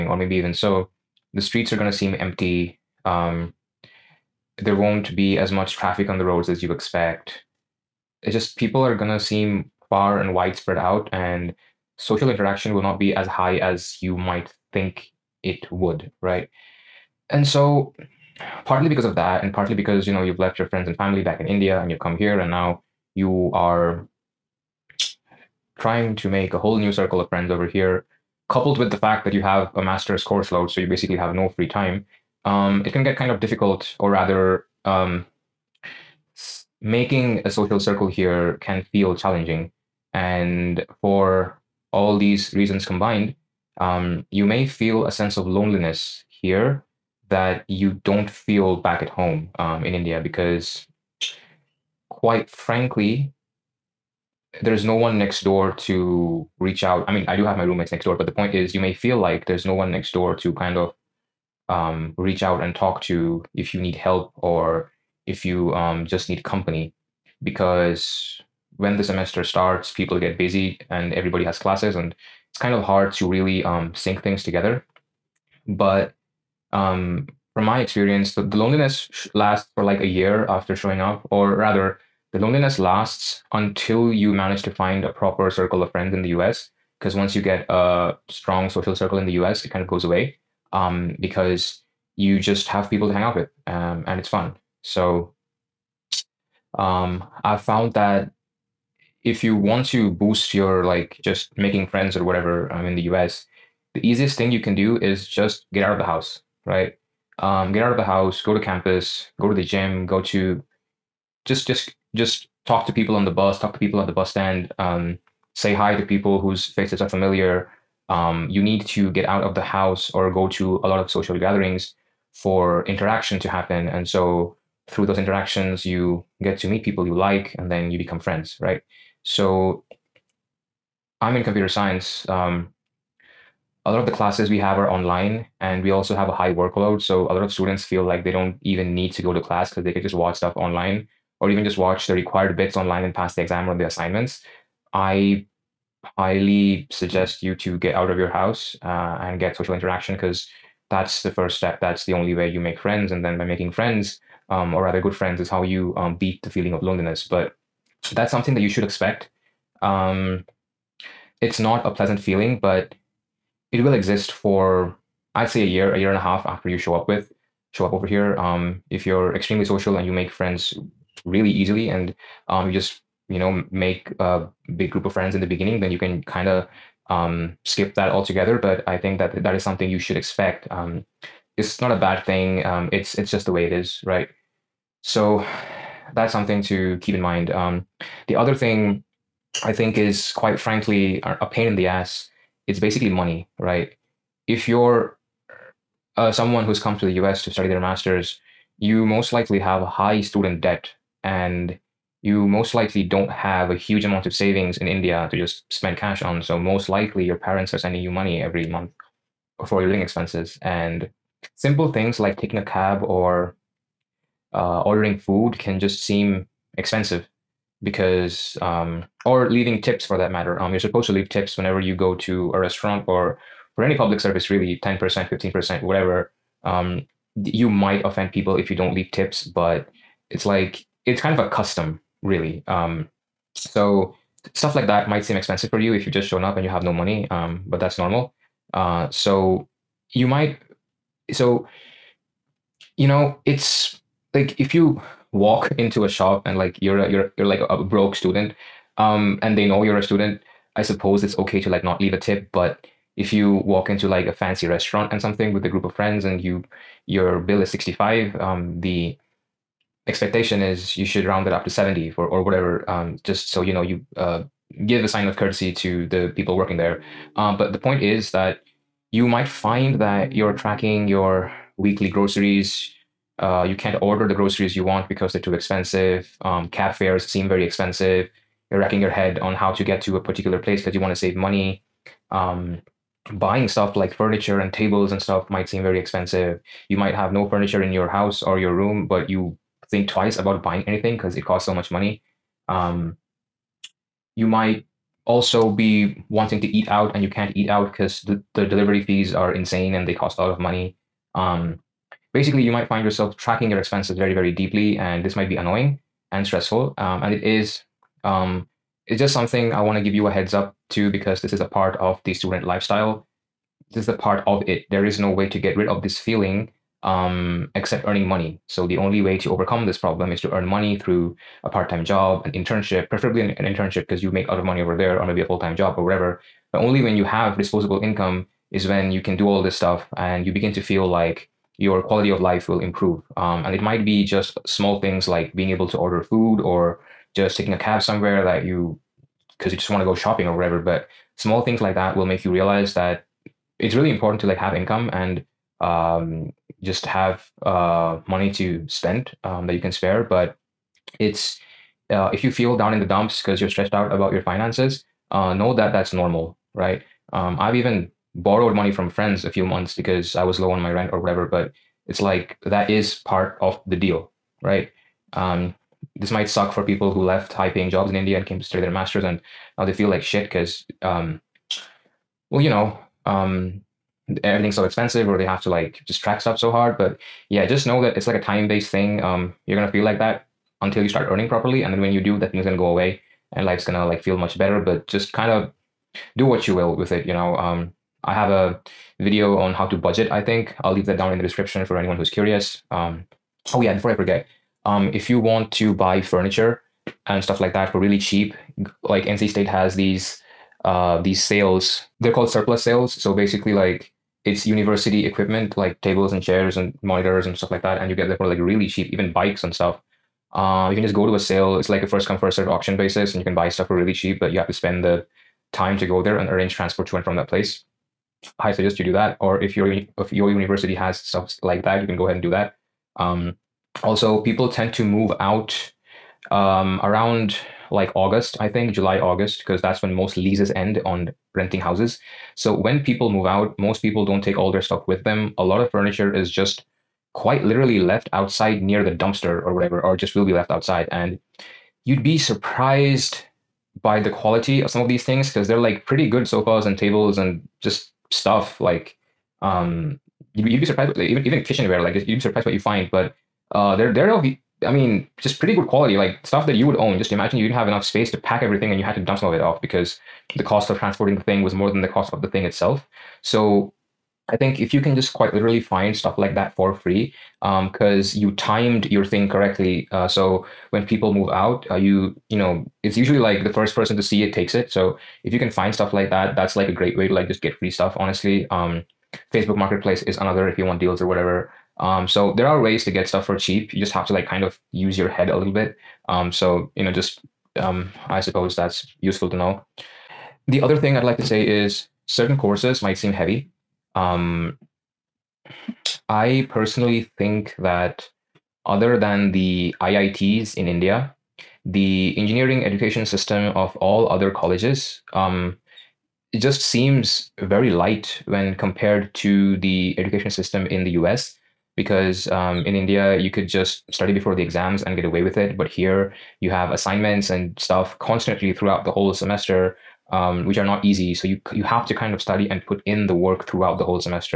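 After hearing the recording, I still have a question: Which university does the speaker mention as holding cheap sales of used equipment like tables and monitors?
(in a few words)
NC State.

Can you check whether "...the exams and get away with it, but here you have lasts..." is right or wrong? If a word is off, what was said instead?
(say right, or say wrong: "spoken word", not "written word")
wrong: "assignments", not "lasts".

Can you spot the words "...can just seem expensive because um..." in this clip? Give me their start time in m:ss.
3:35.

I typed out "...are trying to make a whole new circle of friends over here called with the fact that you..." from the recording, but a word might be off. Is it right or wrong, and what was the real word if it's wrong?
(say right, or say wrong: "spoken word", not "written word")
wrong: "coupled", not "called".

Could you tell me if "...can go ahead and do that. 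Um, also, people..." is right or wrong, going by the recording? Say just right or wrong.
right.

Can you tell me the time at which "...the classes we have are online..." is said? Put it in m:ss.
2:14.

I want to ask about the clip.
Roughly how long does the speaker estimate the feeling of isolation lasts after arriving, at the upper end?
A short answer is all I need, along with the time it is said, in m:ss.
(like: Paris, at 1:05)
a year and a half, at 2:45.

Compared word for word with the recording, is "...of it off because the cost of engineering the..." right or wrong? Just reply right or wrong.
wrong.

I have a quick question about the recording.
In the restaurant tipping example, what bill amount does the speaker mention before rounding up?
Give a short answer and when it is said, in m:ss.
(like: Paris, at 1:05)
65, at 4:17.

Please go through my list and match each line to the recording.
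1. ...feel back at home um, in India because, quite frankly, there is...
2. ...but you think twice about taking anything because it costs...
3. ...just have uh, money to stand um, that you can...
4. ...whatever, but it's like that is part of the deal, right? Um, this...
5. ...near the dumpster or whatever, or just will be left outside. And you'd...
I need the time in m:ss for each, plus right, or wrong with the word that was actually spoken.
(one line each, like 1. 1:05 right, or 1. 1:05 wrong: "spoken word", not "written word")
1. 0:48 right
2. 4:49 wrong: "buying", not "taking"
3. 5:46 wrong: "spend", not "stand"
4. 6:01 right
5. 7:18 right.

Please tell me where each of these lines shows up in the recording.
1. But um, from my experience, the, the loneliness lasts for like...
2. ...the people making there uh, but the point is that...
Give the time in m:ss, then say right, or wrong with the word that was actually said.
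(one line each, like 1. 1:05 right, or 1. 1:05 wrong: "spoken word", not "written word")
1. 1:15 right
2. 4:26 wrong: "working", not "making".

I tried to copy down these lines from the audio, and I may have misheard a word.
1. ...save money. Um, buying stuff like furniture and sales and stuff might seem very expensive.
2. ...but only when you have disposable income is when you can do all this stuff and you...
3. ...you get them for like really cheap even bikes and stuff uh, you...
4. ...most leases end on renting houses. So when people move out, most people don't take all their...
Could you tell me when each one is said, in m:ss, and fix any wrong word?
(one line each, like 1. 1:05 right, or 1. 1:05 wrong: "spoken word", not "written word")
1. 4:41 wrong: "tables", not "sales"
2. 5:26 right
3. 6:48 right
4. 7:10 right.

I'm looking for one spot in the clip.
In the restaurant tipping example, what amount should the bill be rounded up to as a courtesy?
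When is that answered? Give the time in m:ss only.
4:21.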